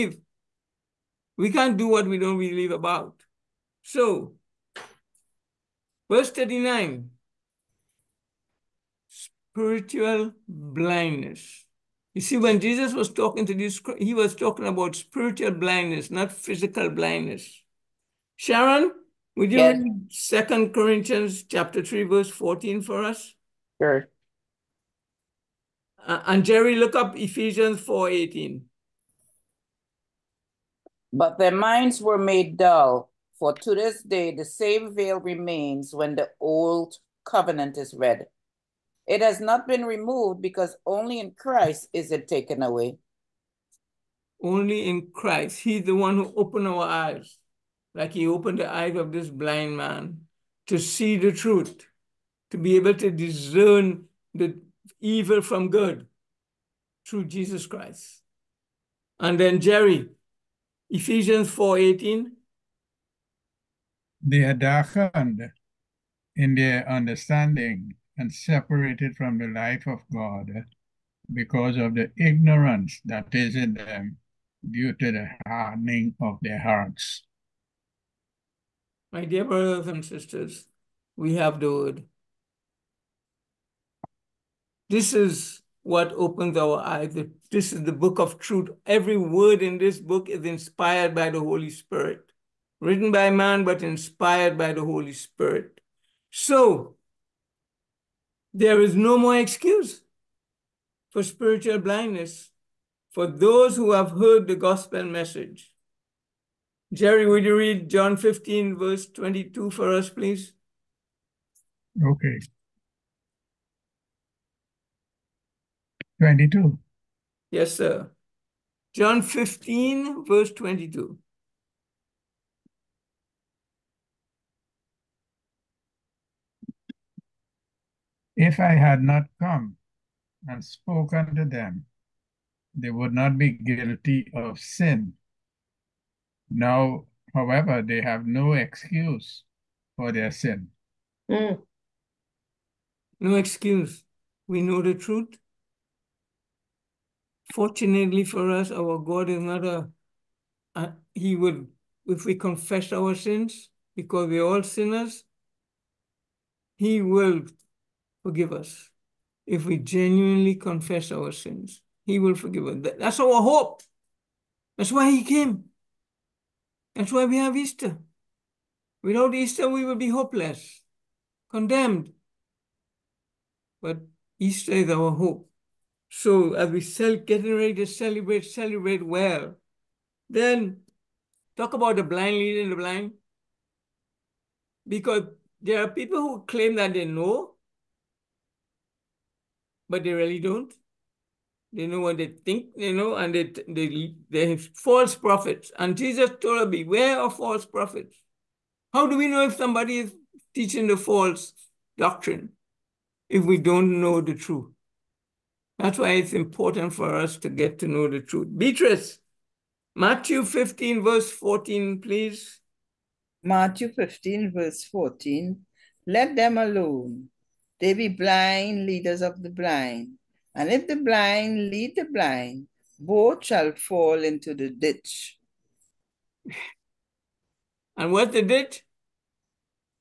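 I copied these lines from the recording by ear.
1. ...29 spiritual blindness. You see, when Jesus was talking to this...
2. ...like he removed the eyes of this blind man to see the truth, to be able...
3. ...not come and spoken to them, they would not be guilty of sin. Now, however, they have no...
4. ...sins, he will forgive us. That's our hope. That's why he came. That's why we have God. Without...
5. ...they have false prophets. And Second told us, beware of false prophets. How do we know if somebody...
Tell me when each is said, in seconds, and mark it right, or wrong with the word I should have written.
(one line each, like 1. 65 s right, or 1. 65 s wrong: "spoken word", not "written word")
1. 6 s wrong: "39", not "29"
2. 47 s wrong: "opened", not "removed"
3. 129 s right
4. 161 s wrong: "Easter", not "God"
5. 194 s wrong: "Jesus", not "Second".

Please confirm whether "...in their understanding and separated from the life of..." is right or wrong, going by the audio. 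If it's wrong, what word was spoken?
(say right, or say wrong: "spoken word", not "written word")
right.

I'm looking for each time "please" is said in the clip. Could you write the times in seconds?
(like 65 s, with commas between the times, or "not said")
110 s, 212 s.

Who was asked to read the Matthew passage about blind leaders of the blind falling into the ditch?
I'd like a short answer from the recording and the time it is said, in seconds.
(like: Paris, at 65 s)
Beatrice, at 208 s.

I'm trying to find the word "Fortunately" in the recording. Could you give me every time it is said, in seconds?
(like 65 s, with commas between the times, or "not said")
147 s.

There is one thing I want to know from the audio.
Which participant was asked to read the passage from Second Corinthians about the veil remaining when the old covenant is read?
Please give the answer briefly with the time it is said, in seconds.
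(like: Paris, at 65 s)
Sharon, at 18 s.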